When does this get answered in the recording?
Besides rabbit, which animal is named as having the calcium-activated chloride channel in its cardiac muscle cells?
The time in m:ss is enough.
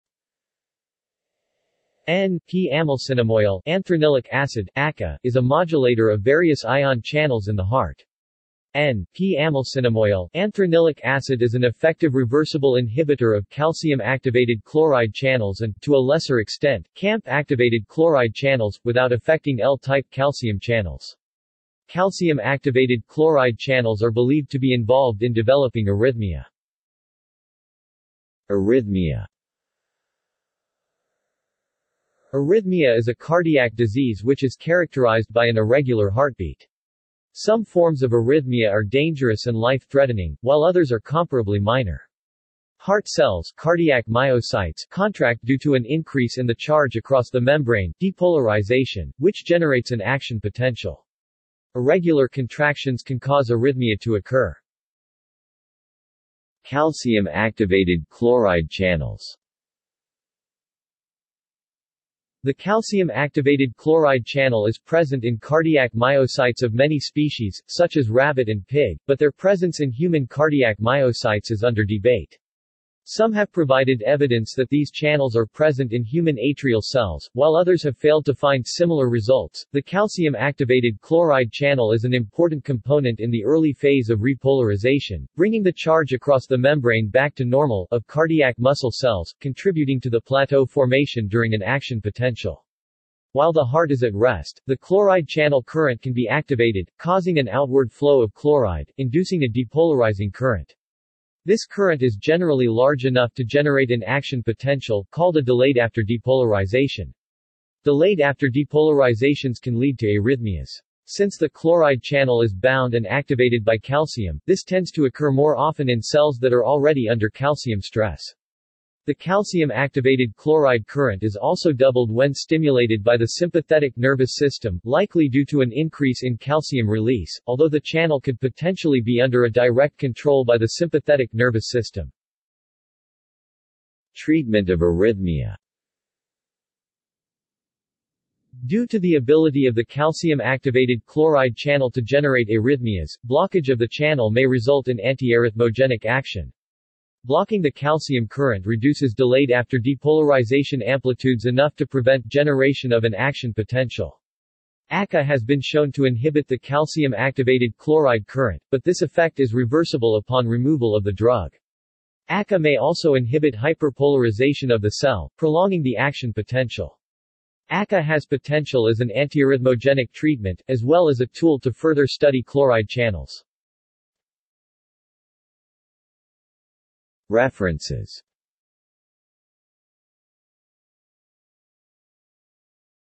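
1:08.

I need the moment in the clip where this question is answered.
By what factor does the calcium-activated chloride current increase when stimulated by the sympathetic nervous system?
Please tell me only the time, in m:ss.
2:01.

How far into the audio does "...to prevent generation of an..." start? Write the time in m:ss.
2:31.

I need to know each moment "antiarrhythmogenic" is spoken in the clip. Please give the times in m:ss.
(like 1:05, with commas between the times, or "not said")
2:24, 2:49.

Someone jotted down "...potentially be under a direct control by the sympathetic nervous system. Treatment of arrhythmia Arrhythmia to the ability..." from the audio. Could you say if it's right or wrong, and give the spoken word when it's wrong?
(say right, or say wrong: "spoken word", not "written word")
wrong: "Due", not "Arrhythmia".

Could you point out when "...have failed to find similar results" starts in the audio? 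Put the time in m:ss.
1:17.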